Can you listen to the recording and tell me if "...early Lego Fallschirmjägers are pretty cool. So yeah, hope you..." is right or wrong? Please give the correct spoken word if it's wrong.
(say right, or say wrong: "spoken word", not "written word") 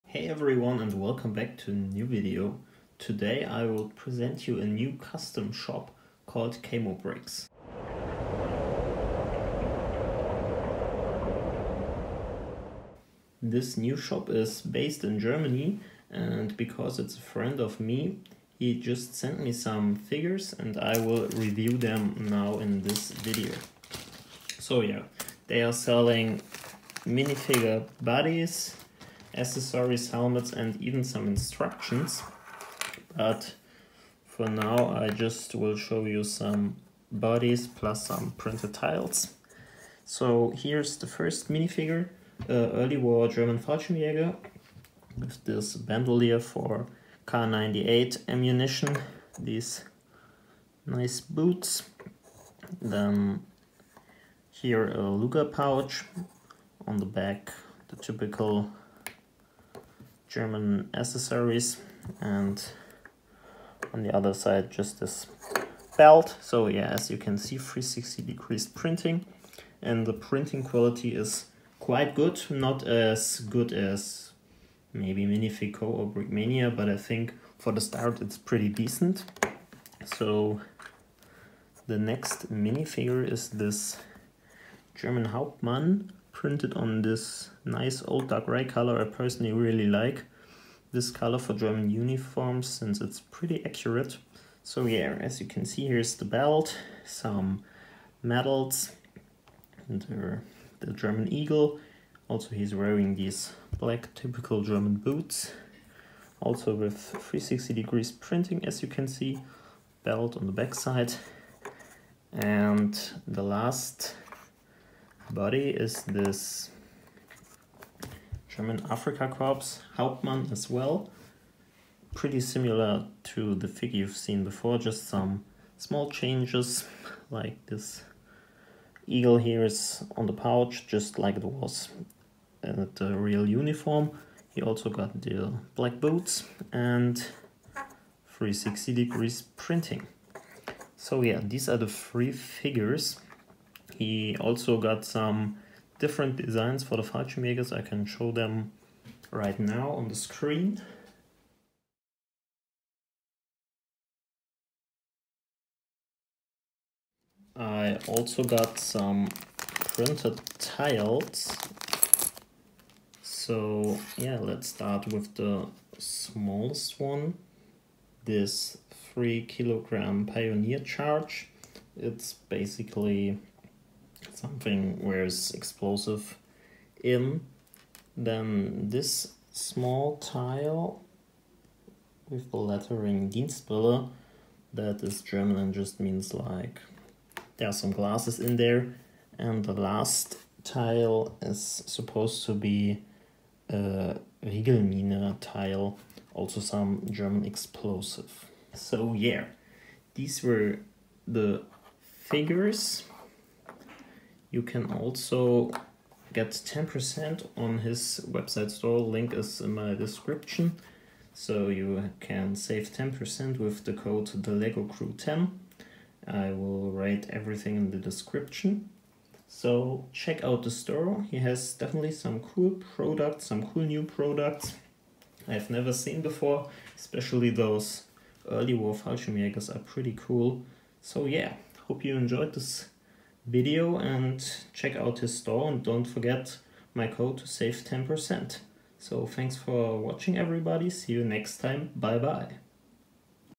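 wrong: "War", not "Lego".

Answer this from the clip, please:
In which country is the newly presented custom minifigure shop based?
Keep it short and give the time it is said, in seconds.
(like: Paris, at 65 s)
Germany, at 15 s.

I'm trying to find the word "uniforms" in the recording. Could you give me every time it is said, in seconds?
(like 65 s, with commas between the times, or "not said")
91 s, 133 s.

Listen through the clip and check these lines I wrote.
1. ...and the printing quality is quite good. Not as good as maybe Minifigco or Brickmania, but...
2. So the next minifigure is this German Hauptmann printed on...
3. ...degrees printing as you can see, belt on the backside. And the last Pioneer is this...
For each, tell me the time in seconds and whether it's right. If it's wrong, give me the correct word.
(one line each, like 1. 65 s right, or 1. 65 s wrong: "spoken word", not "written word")
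1. 69 s right
2. 80 s right
3. 107 s wrong: "Body", not "Pioneer".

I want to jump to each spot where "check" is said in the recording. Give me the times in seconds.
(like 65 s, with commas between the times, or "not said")
220 s, 234 s.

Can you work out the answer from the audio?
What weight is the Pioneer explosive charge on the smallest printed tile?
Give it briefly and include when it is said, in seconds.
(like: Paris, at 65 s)
3 kilograms, at 168 s.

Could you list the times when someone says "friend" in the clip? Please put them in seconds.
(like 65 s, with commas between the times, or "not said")
17 s.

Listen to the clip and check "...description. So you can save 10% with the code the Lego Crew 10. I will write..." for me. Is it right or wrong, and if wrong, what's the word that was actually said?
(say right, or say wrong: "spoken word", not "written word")
right.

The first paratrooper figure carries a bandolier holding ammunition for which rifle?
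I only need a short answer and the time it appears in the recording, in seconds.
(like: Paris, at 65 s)
Kar 98, at 47 s.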